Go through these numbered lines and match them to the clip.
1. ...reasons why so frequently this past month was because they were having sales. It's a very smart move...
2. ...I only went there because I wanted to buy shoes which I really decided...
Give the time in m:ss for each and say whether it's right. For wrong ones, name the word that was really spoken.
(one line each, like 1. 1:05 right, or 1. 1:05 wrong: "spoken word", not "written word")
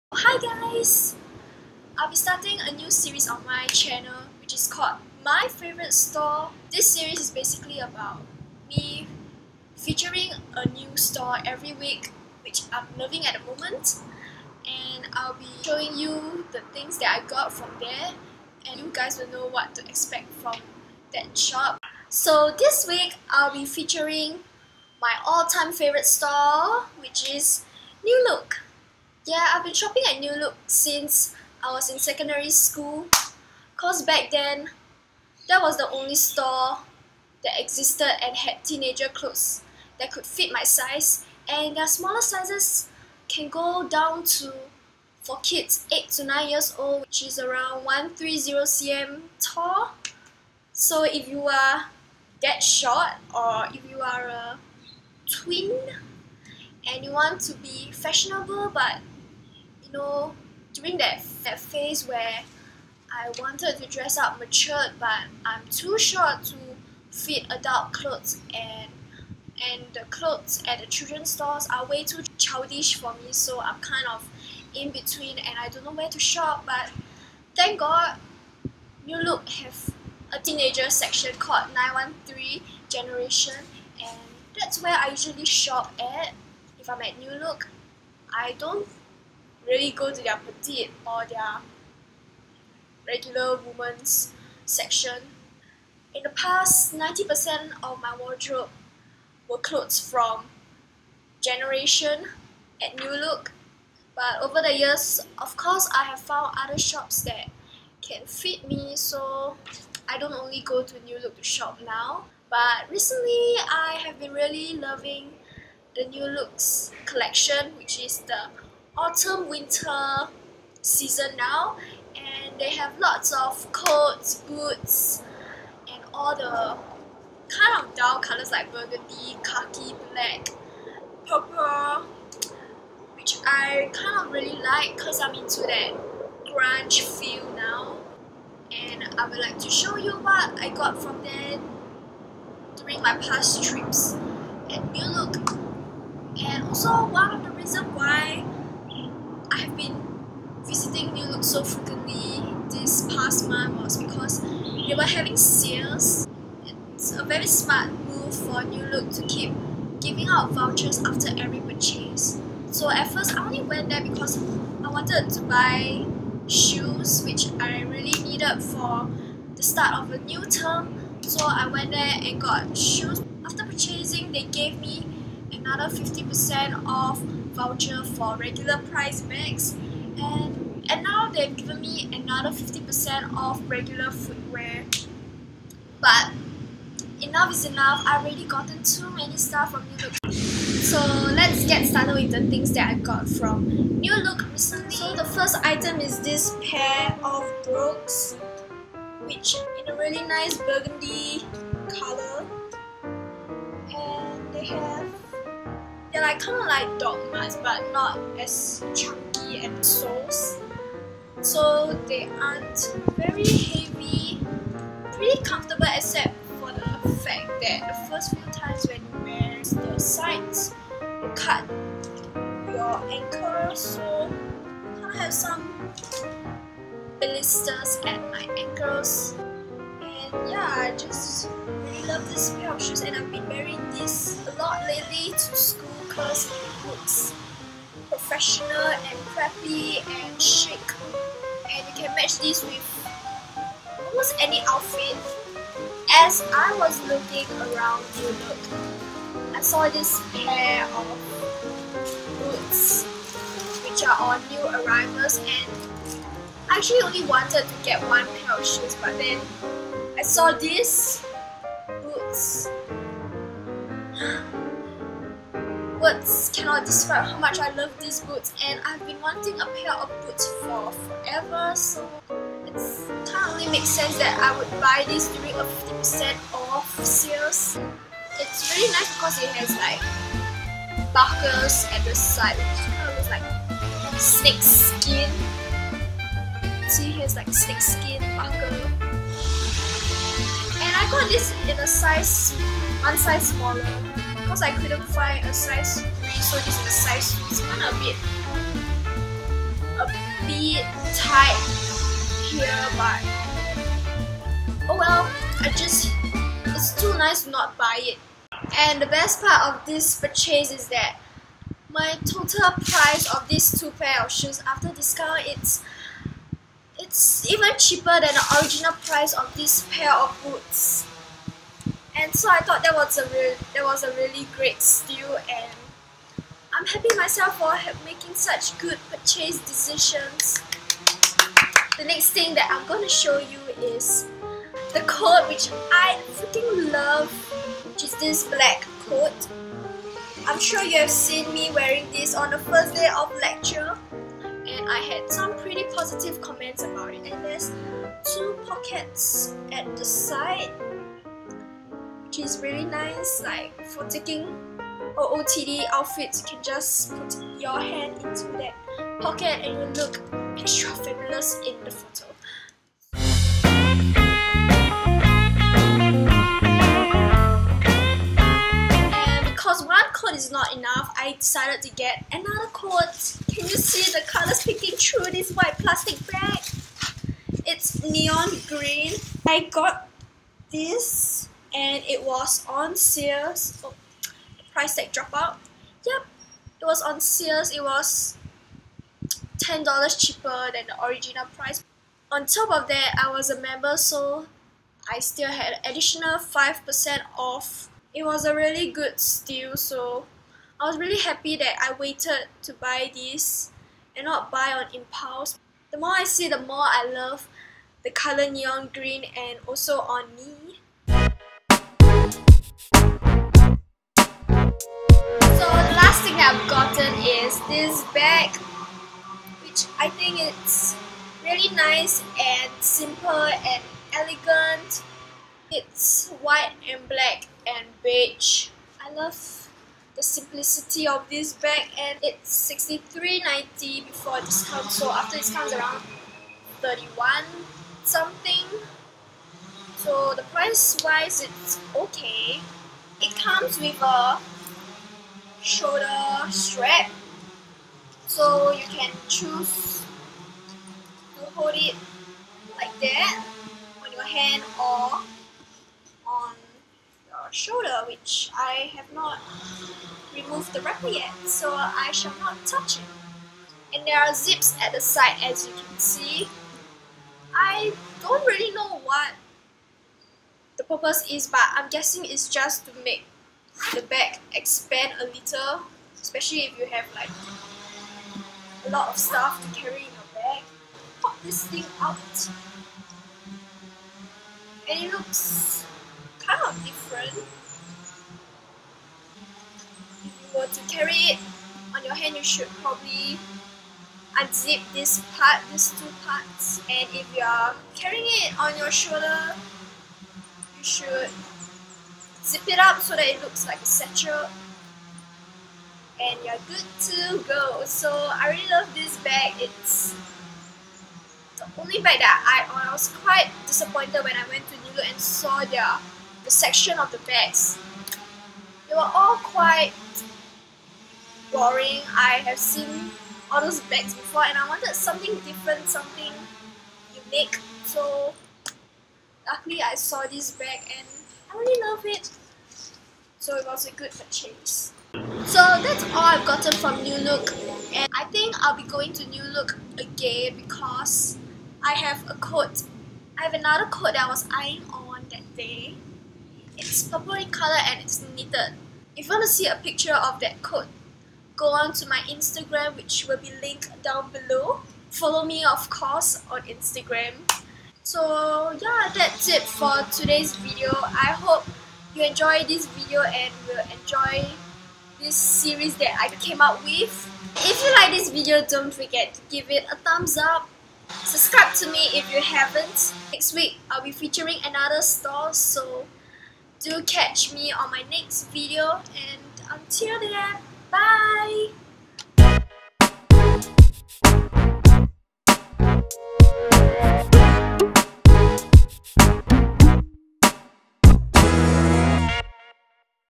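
1. 2:27 right
2. 2:43 wrong: "needed", not "decided".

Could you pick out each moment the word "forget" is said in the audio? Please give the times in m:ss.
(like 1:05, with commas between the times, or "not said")
9:28.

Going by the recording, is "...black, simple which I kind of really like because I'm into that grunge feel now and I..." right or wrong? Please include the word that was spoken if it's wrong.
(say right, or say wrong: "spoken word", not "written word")
wrong: "purple", not "simple".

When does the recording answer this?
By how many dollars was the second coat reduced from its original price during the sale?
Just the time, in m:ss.
6:29.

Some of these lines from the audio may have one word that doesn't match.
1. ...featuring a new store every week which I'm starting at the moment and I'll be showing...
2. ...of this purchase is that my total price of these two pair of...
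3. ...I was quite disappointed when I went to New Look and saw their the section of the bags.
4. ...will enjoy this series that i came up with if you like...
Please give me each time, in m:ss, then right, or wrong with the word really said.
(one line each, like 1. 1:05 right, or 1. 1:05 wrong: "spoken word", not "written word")
1. 0:09 wrong: "loving", not "starting"
2. 5:09 right
3. 8:32 right
4. 9:23 right.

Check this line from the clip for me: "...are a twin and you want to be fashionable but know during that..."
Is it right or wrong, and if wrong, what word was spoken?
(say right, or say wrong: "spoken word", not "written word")
right.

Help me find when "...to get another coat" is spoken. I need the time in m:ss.
6:11.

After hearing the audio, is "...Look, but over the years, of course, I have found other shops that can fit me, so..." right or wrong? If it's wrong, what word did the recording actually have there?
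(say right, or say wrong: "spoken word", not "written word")
right.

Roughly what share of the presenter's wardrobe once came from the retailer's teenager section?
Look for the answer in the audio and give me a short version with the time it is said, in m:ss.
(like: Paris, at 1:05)
90%, at 1:36.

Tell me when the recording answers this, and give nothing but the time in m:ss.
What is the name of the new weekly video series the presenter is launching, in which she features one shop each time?
0:05.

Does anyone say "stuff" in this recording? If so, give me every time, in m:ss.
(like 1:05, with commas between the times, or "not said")
3:09, 7:59.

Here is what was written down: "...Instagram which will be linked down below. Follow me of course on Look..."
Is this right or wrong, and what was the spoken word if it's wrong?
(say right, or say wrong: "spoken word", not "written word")
wrong: "Instagram", not "Look".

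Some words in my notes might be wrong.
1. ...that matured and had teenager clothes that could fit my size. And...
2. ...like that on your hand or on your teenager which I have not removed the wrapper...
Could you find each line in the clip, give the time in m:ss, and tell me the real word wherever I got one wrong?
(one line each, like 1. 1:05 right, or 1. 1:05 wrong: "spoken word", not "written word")
1. 0:37 wrong: "existed", not "matured"
2. 7:32 wrong: "shoulder", not "teenager".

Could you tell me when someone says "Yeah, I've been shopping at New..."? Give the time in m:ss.
0:29.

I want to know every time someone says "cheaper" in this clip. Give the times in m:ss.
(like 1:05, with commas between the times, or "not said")
5:17, 6:30.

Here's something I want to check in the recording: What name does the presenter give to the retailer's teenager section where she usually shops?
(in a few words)
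Nine One Three Generation.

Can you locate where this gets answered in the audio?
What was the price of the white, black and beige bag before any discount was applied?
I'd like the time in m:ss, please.
7:12.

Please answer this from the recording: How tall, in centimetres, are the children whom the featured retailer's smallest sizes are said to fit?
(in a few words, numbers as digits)
130 cm.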